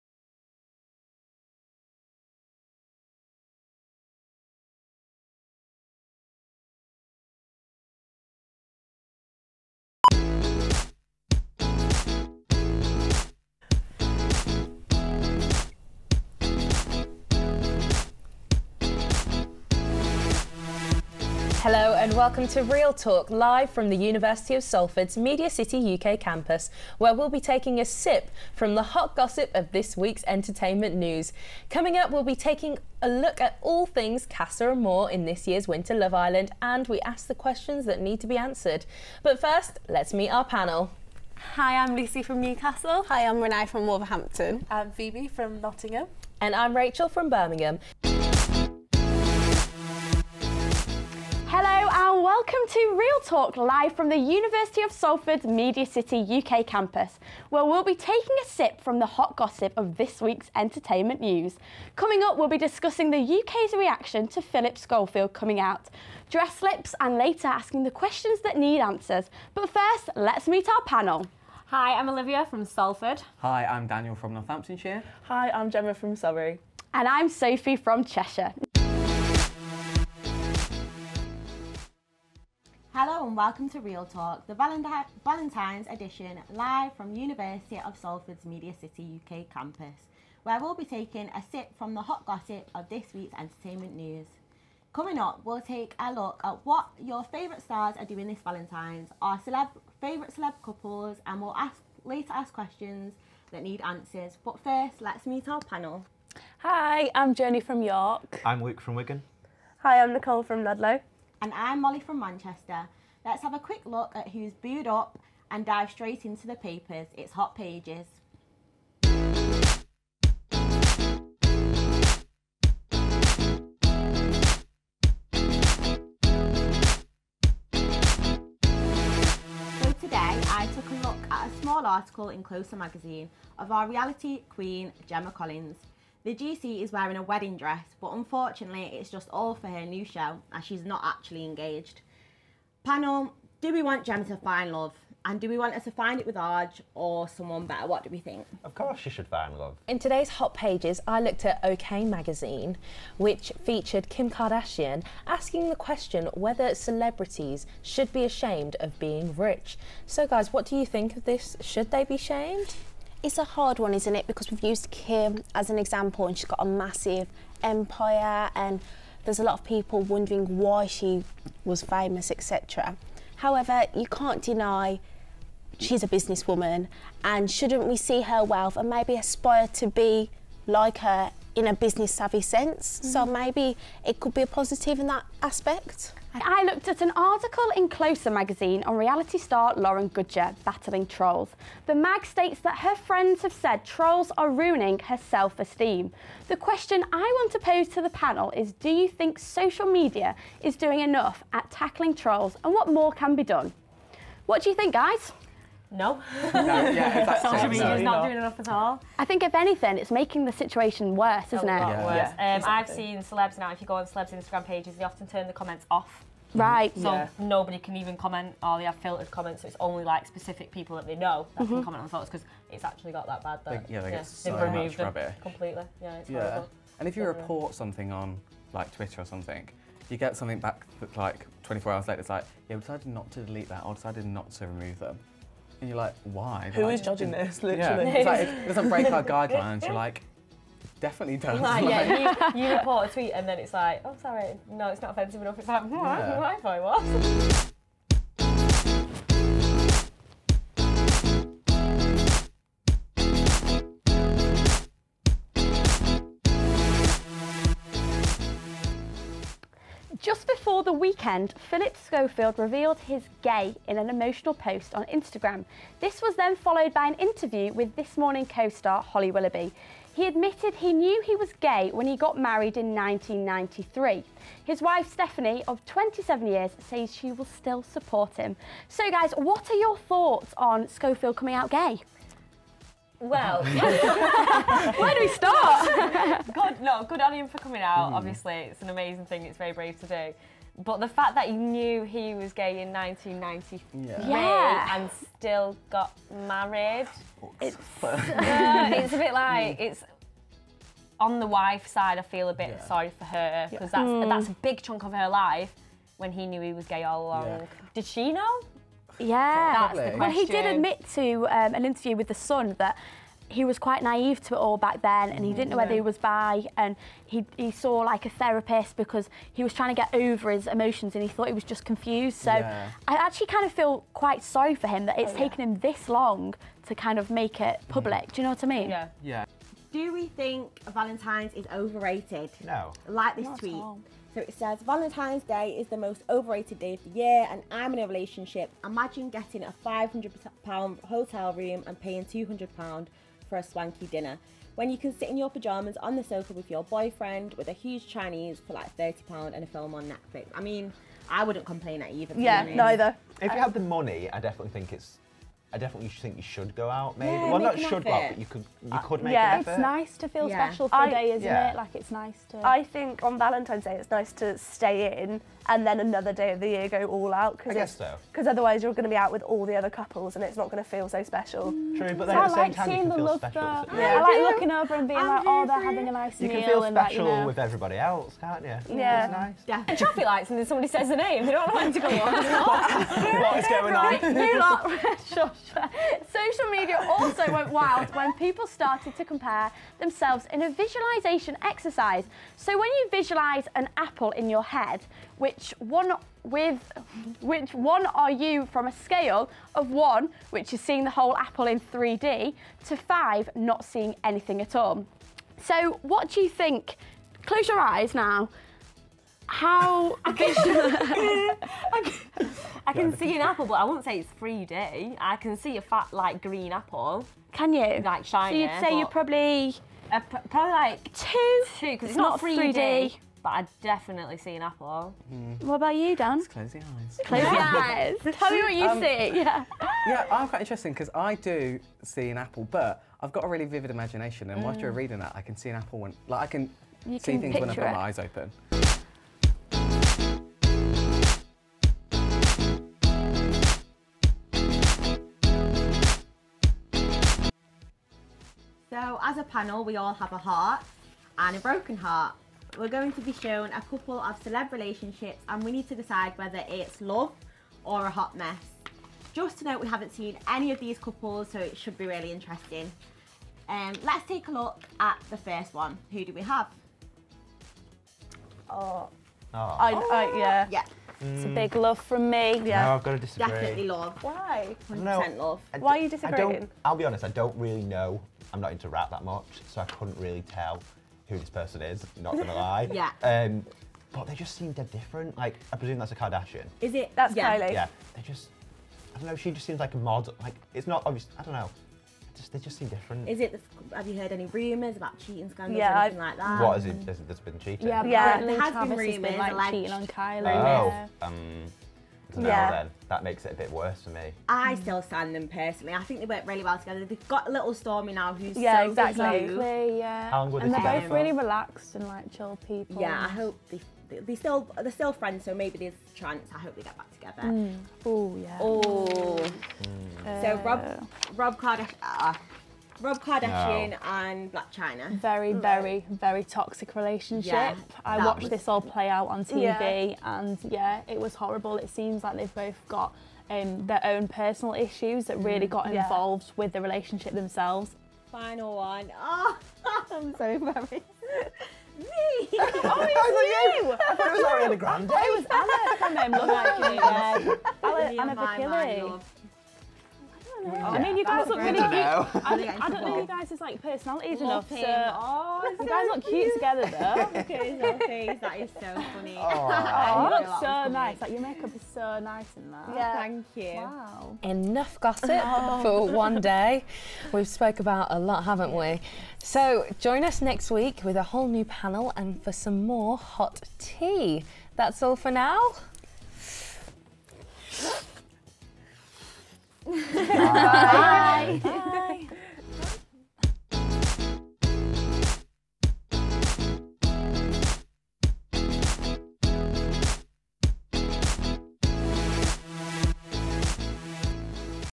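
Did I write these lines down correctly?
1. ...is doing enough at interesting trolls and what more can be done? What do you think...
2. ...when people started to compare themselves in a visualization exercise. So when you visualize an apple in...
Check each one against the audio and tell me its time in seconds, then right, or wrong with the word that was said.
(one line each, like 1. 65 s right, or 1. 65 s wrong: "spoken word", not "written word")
1. 200 s wrong: "tackling", not "interesting"
2. 388 s right.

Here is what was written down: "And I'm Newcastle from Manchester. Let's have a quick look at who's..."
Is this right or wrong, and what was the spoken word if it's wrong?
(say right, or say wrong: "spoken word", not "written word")
wrong: "Molly", not "Newcastle".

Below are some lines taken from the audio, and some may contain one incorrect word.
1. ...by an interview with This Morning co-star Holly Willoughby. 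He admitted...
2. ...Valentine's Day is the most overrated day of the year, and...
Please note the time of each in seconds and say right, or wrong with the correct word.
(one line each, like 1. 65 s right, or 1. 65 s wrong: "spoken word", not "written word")
1. 266 s right
2. 334 s right.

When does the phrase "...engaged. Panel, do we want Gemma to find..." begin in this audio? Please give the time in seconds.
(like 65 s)
141 s.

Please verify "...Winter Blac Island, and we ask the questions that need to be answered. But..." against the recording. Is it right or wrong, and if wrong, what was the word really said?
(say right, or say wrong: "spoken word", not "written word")
wrong: "Love", not "Blac".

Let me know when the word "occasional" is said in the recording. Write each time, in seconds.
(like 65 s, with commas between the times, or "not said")
not said.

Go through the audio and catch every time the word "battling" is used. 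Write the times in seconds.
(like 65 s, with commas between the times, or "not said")
190 s.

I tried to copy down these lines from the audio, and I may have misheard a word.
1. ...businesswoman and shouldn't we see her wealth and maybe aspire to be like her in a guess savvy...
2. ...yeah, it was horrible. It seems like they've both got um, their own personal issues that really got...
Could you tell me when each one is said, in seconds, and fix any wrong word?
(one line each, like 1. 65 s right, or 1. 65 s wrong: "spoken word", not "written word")
1. 176 s wrong: "business", not "guess"
2. 530 s right.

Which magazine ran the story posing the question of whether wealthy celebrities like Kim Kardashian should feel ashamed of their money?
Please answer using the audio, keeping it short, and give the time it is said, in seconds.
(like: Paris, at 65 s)
OK Magazine, at 151 s.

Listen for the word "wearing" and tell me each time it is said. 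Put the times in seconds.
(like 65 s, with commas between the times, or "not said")
136 s.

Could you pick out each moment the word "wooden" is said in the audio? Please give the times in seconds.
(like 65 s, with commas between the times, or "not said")
not said.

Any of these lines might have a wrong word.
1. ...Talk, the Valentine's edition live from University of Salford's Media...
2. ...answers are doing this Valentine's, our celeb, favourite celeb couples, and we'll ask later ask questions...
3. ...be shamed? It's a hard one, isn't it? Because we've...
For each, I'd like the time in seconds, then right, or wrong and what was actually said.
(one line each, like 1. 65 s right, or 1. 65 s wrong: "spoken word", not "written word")
1. 84 s right
2. 97 s wrong: "stars", not "answers"
3. 162 s right.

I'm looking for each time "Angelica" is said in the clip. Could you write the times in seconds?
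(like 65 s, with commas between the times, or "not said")
not said.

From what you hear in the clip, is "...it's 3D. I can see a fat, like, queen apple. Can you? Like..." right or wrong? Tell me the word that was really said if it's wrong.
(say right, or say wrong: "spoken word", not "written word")
wrong: "green", not "queen".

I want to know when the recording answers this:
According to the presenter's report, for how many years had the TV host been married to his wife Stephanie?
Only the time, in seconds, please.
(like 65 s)
275 s.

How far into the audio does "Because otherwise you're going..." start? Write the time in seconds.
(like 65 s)
368 s.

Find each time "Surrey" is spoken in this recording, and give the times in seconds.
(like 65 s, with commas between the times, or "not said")
76 s.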